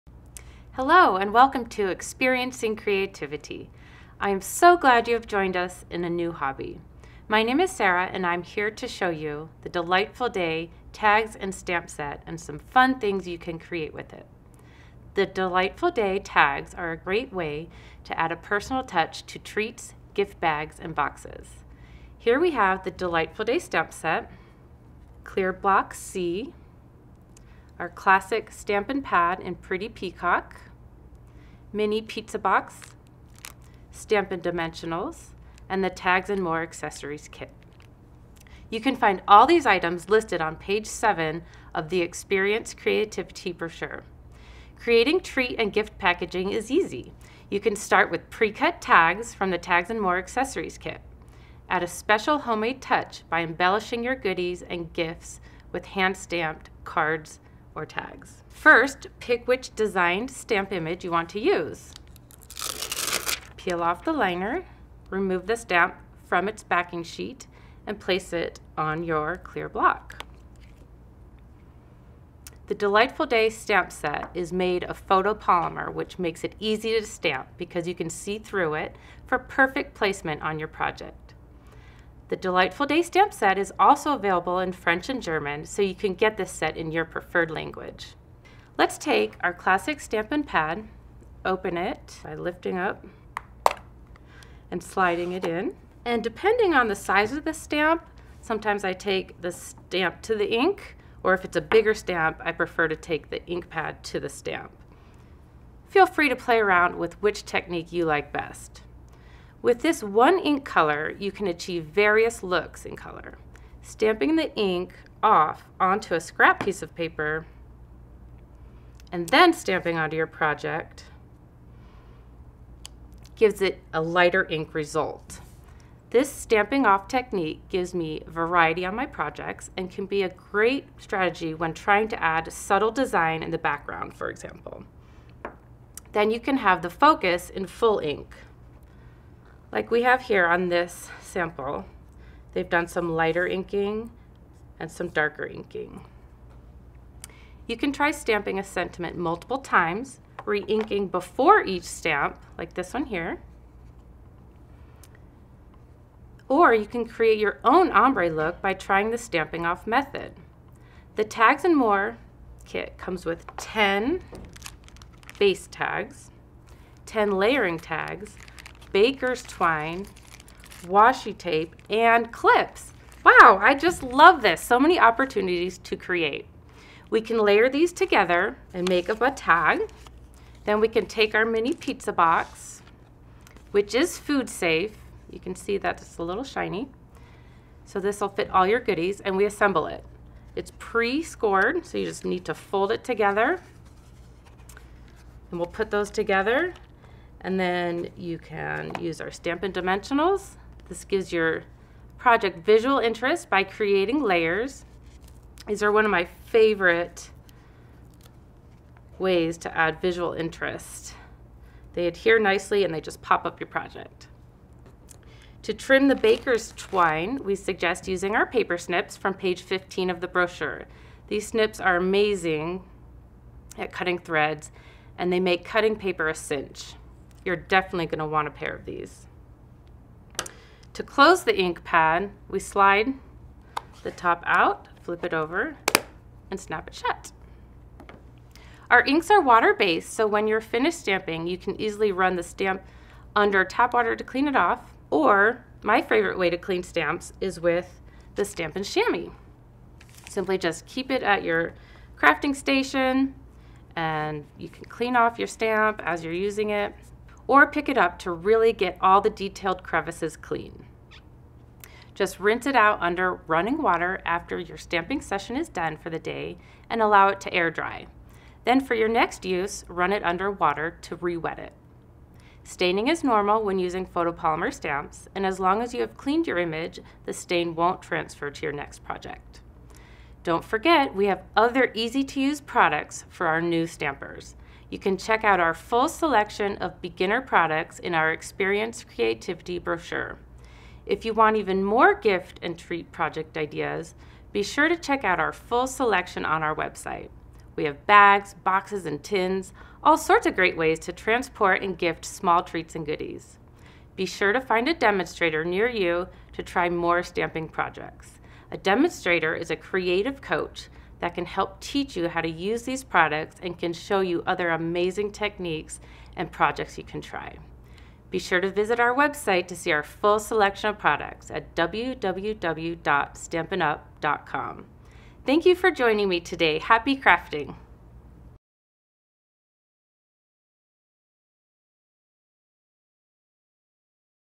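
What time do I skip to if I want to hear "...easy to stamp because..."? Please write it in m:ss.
1:16.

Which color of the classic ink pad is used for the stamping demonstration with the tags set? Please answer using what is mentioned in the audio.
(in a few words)
Pretty Peacock.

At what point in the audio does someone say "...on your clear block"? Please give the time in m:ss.
1:08.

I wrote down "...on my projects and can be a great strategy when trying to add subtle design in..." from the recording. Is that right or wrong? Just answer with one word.
right.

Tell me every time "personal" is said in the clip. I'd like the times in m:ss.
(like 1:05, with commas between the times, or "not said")
0:18.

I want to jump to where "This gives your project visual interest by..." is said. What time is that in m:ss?
3:20.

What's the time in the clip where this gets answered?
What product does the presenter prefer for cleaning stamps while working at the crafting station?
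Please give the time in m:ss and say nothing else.
4:08.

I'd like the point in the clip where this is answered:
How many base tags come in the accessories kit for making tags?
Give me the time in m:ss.
2:43.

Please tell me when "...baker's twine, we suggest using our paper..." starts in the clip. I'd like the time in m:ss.
3:36.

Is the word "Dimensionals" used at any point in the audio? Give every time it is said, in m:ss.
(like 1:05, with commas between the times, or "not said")
0:34, 3:19.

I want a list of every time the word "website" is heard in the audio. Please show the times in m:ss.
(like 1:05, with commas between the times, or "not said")
4:56, 5:19.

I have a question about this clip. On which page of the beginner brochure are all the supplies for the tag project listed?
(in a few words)
7.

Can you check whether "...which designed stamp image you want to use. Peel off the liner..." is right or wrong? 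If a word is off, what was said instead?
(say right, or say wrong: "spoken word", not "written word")
right.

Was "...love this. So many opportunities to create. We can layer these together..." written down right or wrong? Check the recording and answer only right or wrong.
right.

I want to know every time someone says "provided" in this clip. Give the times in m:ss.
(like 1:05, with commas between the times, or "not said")
not said.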